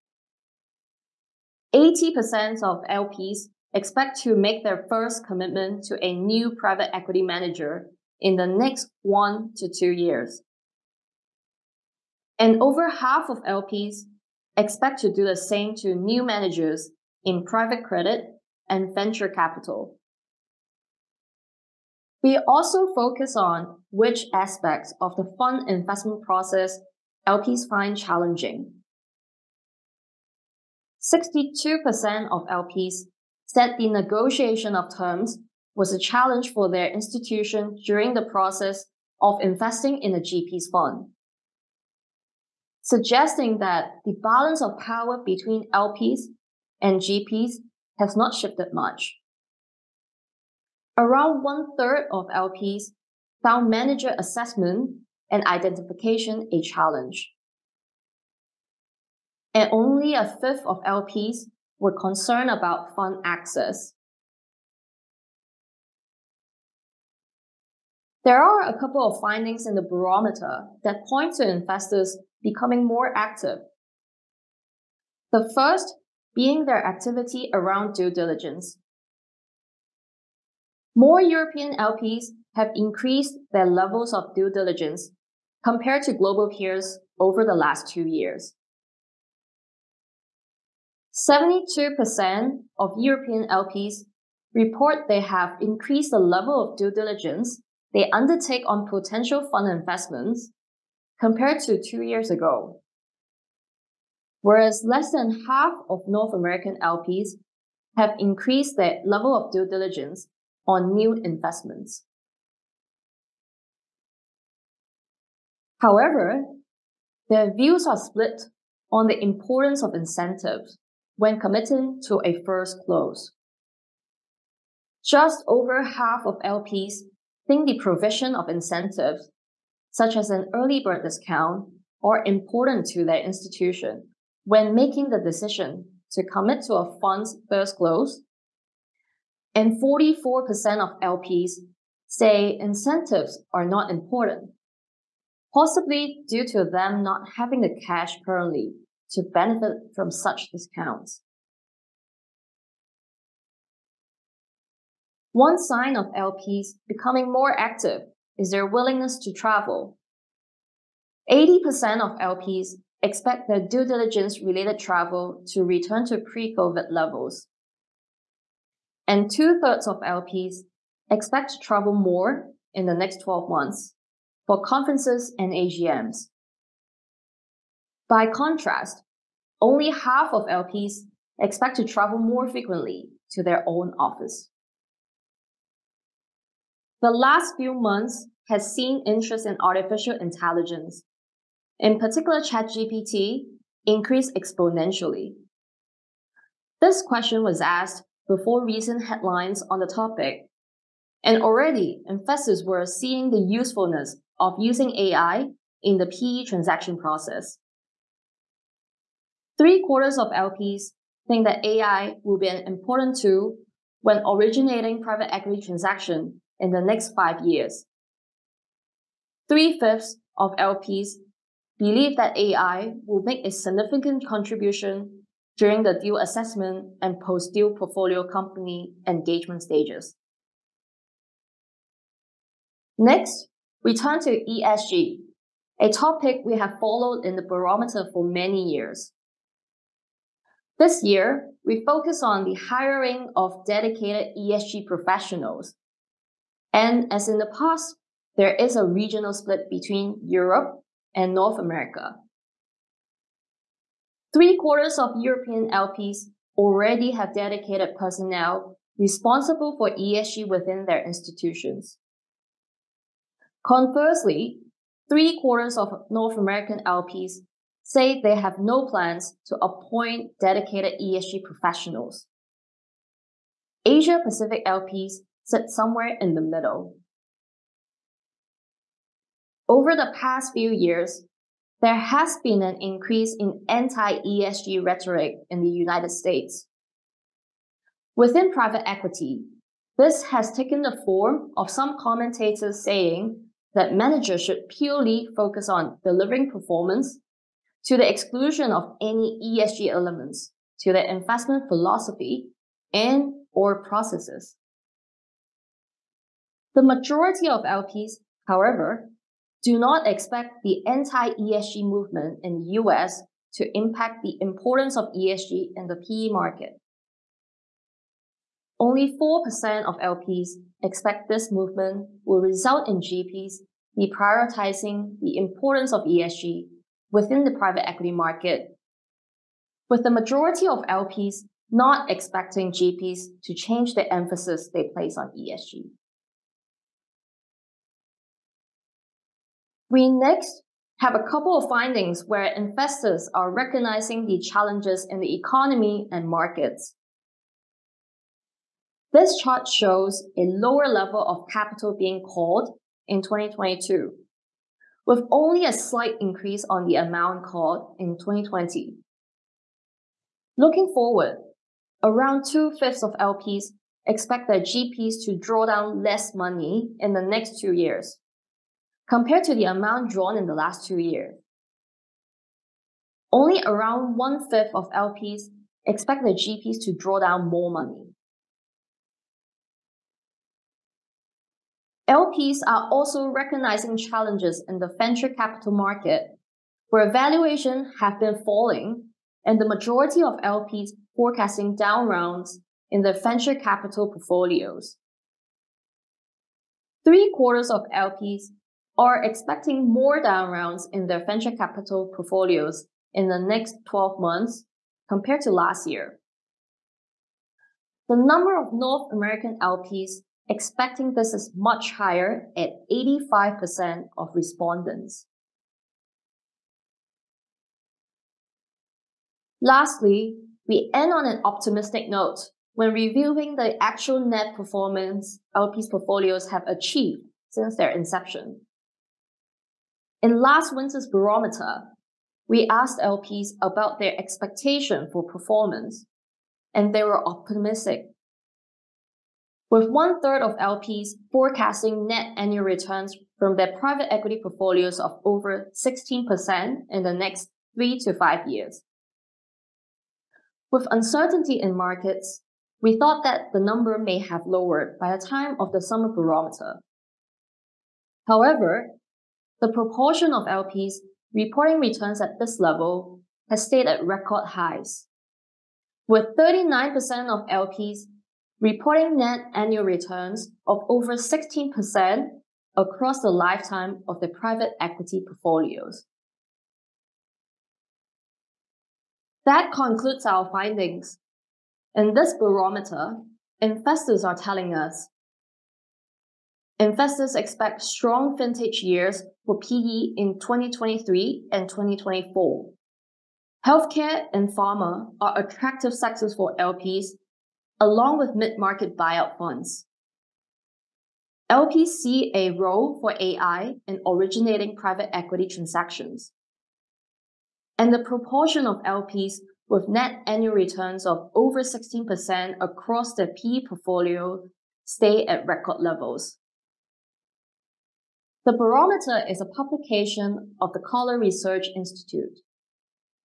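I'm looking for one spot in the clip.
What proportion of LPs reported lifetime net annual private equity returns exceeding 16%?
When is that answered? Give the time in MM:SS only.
07:46.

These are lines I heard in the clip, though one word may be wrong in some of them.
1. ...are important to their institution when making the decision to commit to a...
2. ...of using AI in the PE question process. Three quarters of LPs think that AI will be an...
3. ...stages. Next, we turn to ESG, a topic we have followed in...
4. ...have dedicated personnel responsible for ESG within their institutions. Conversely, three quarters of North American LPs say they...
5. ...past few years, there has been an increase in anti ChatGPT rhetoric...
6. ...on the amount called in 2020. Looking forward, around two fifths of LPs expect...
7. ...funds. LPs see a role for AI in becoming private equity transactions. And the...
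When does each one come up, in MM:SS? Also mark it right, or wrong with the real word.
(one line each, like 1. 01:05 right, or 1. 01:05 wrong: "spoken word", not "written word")
1. 02:12 right
2. 03:24 wrong: "transaction", not "question"
3. 03:49 right
4. 04:17 right
5. 04:40 wrong: "ESG", not "ChatGPT"
6. 05:56 right
7. 08:19 wrong: "originating", not "becoming".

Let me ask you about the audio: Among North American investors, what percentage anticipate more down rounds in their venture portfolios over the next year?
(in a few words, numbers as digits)
85%.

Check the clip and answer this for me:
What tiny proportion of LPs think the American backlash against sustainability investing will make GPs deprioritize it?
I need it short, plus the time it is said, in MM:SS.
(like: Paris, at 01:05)
4%, at 05:19.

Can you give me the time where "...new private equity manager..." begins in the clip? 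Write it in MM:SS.
00:06.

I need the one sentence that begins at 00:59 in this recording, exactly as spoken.
And only a fifth of LPs were concerned about fund access.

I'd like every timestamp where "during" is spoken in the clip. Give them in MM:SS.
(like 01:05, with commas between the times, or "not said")
00:37, 03:45.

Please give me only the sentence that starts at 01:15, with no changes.
The first being their activity around due diligence.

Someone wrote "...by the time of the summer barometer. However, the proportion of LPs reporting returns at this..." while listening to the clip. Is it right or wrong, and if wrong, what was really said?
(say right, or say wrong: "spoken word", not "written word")
right.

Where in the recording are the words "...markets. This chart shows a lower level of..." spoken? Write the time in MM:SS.
05:46.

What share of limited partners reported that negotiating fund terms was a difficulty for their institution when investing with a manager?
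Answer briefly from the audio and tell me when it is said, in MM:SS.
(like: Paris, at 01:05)
62%, at 00:31.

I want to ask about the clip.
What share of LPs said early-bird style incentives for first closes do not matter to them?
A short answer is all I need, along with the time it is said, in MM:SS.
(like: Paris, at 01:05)
44%, at 02:19.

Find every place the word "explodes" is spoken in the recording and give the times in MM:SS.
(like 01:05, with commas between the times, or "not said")
not said.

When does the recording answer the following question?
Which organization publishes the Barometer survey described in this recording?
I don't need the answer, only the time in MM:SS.
08:40.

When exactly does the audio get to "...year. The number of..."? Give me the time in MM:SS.
06:45.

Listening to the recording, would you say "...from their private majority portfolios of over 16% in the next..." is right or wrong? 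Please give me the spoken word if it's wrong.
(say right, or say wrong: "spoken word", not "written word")
wrong: "equity", not "majority".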